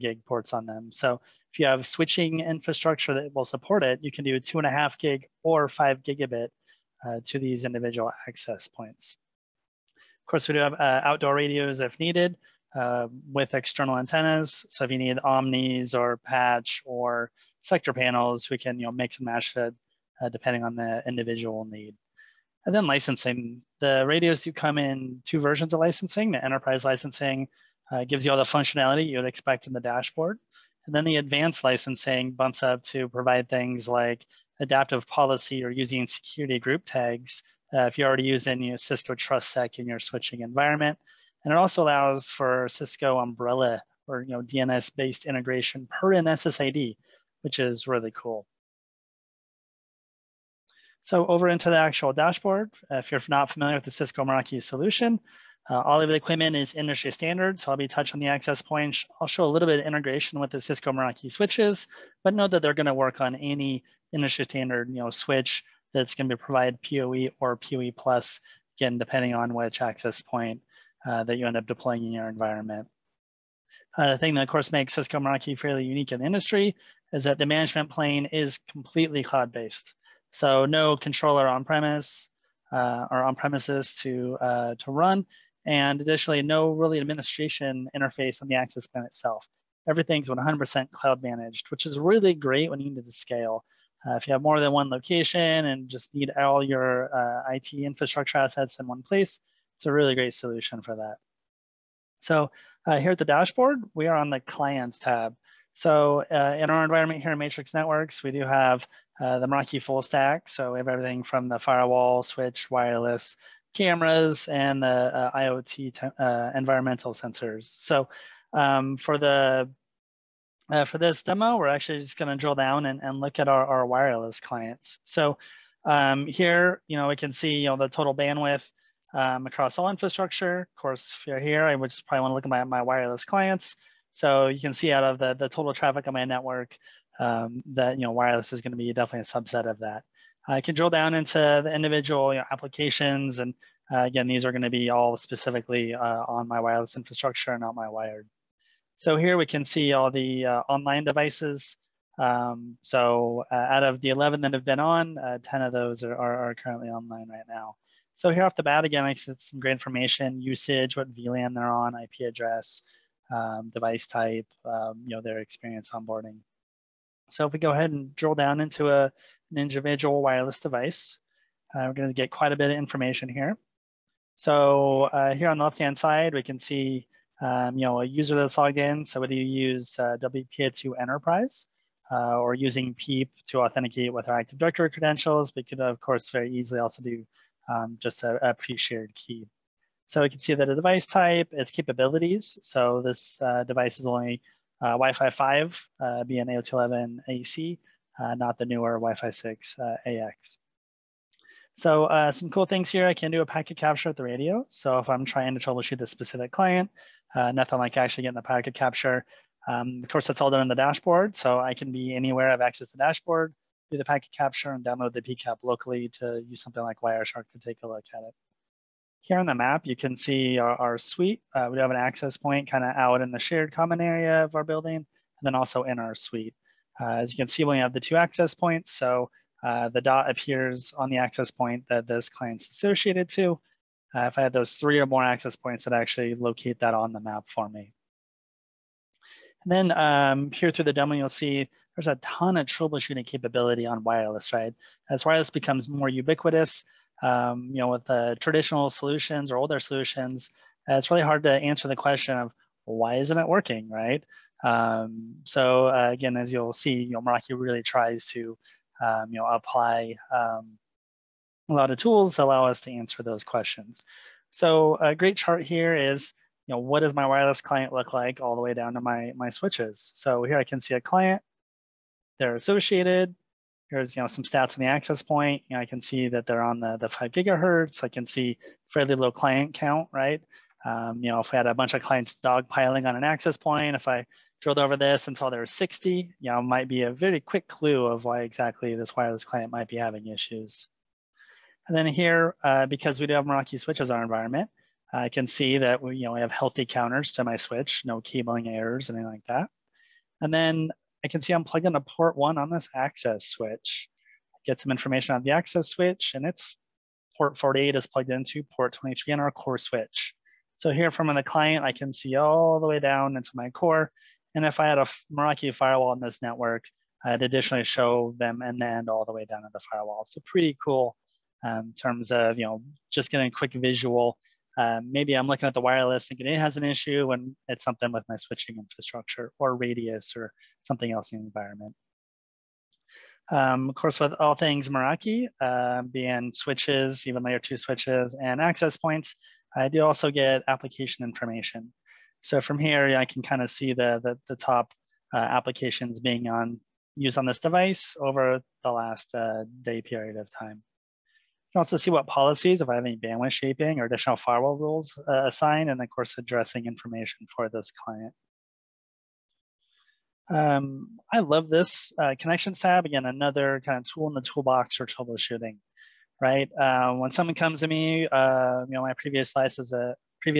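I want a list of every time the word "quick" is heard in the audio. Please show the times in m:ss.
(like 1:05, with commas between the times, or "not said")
4:47, 5:23.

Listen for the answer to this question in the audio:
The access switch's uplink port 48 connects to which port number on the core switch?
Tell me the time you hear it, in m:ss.
5:08.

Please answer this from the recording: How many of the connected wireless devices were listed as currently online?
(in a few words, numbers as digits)
10.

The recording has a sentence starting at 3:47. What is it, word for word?
Uh, as you can see, we have the two access points.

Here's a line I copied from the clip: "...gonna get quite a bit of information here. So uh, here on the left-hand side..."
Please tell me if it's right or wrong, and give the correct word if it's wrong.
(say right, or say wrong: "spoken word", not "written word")
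right.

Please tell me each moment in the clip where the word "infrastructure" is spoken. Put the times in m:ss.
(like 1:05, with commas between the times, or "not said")
0:02, 1:37, 2:09, 2:26, 5:28.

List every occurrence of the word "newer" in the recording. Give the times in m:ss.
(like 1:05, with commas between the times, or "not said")
3:18.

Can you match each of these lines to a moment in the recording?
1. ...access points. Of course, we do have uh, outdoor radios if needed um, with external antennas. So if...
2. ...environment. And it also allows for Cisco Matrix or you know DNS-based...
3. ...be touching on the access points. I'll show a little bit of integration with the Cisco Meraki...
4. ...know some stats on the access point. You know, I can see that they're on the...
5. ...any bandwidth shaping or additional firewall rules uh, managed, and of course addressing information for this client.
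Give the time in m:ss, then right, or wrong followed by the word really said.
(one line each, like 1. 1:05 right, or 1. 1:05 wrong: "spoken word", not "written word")
1. 0:08 right
2. 0:40 wrong: "Umbrella", not "Matrix"
3. 0:57 right
4. 4:34 right
5. 5:53 wrong: "assigned", not "managed".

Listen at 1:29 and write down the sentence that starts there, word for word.
Everything's 100% cloud managed, which is really great when you need to scale.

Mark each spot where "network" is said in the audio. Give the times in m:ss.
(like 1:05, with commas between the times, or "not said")
1:47, 2:16, 5:16.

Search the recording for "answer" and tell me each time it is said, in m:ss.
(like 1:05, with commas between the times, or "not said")
4:11, 4:22.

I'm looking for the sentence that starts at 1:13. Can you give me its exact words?
Uh, the thing that, of course, makes Cisco Meraki fairly unique in the industry is that the management plane is completely cloud-based.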